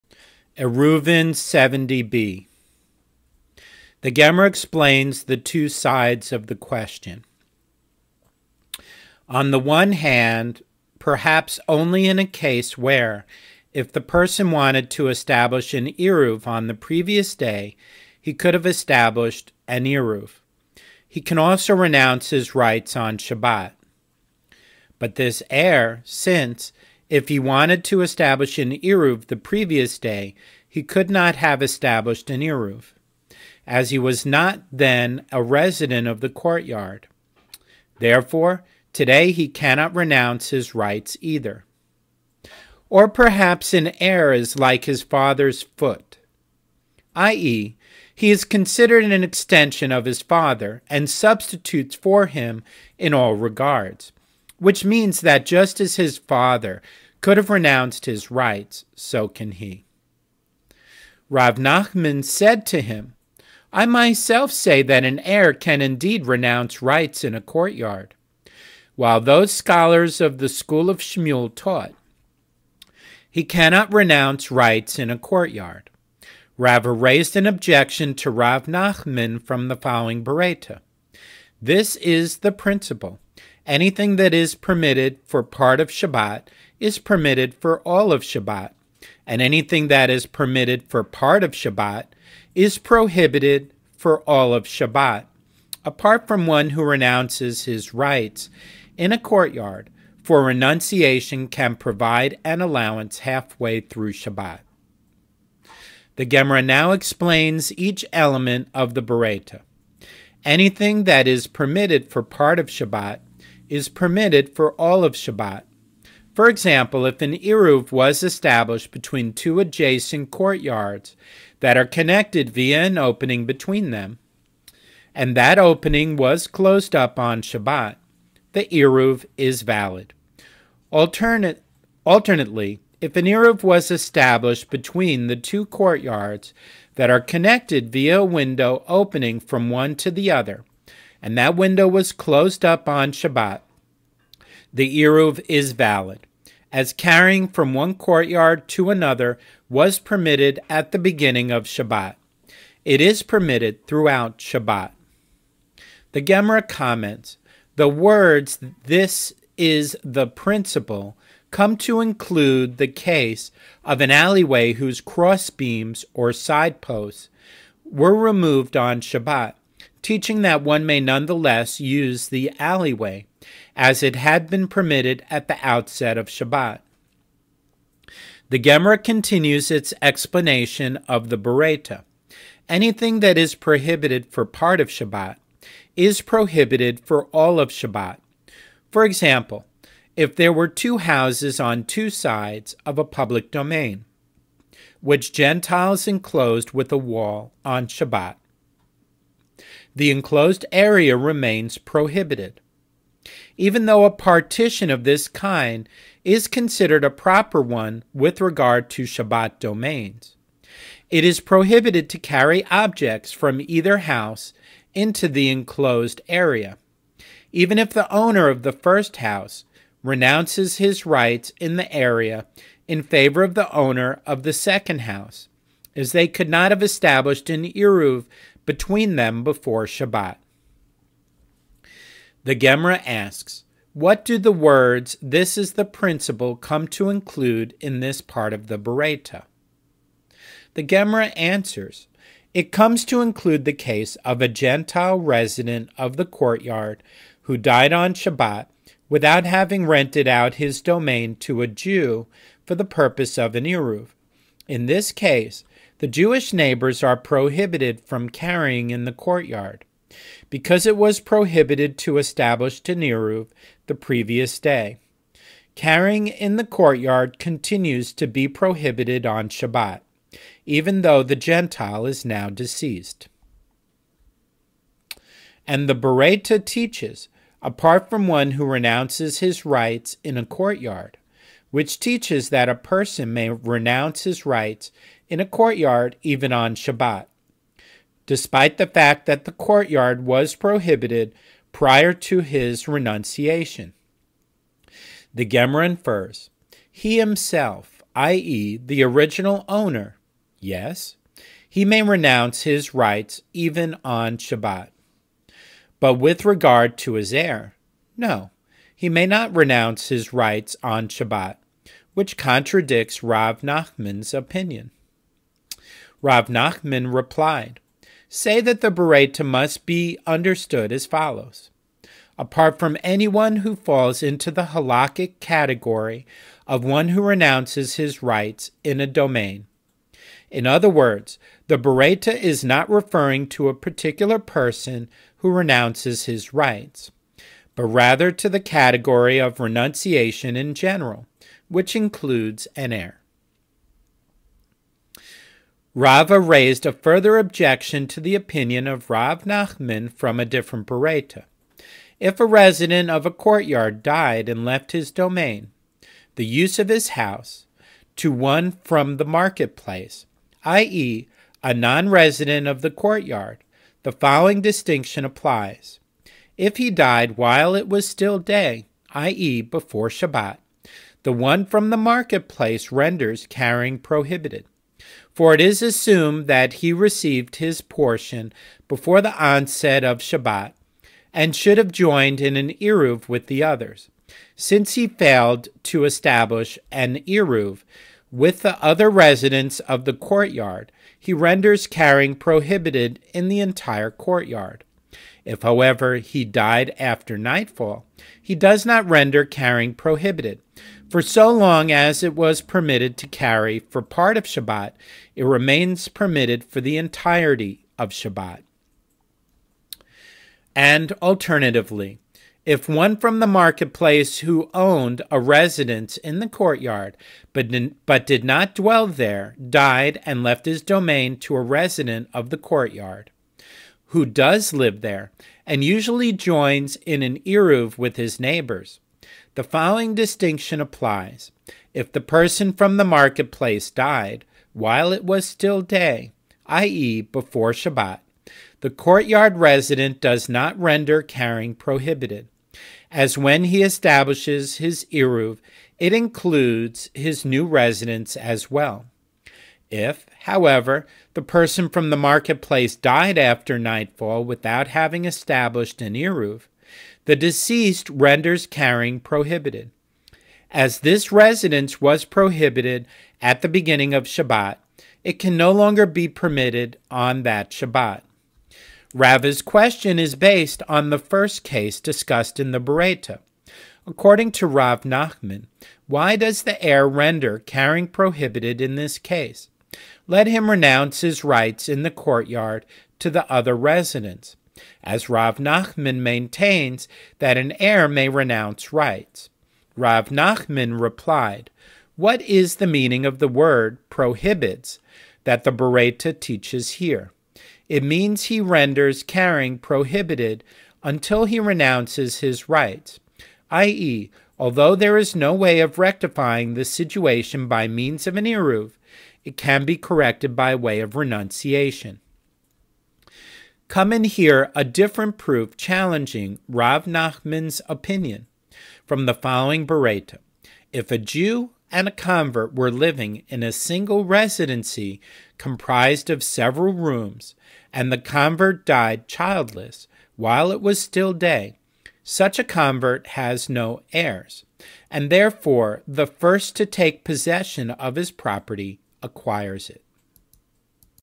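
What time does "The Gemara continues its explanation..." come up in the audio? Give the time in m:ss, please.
2:58.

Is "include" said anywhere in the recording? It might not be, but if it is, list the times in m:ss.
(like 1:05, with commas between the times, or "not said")
2:41, 3:57, 4:03, 5:41, 7:26.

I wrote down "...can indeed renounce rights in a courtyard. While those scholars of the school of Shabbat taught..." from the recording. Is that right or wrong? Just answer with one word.
wrong.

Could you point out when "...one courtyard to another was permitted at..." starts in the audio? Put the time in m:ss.
2:27.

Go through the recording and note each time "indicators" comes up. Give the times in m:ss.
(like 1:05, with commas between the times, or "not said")
not said.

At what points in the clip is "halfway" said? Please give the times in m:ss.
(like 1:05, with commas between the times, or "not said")
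1:43.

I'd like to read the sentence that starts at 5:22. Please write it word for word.
Apart from anyone who falls into the halakhic category of one who renounces his rights in a domain.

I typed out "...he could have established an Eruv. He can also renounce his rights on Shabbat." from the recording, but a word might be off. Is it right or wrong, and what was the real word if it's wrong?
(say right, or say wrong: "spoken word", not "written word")
right.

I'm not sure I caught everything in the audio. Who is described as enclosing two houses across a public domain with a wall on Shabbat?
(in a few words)
Gentiles.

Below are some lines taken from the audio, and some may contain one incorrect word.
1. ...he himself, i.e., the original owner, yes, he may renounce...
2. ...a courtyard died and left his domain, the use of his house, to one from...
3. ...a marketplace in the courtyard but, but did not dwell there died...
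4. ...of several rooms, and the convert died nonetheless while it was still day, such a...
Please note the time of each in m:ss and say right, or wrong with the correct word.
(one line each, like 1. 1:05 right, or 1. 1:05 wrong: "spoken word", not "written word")
1. 4:56 right
2. 5:53 right
3. 6:55 wrong: "residence", not "marketplace"
4. 8:46 wrong: "childless", not "nonetheless".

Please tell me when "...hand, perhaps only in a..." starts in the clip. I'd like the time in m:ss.
0:09.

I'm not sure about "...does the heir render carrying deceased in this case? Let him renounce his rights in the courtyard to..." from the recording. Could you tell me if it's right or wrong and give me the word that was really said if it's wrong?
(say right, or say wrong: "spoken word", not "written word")
wrong: "prohibited", not "deceased".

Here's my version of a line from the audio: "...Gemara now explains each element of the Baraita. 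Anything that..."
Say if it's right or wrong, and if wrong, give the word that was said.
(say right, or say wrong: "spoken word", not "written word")
right.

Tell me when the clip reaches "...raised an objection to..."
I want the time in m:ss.
1:16.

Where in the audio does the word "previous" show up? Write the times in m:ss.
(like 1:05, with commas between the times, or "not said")
0:16, 0:29, 4:23.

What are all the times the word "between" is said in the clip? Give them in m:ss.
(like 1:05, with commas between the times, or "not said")
1:58, 2:03, 2:14, 3:48.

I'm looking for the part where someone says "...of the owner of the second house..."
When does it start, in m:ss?
3:43.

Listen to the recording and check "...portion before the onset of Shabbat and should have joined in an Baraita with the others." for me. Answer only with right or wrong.
wrong.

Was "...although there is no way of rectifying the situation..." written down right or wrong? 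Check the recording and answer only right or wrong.
right.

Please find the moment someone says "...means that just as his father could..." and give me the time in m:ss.
0:54.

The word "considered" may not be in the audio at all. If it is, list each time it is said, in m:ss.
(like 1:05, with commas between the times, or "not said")
0:48, 3:26.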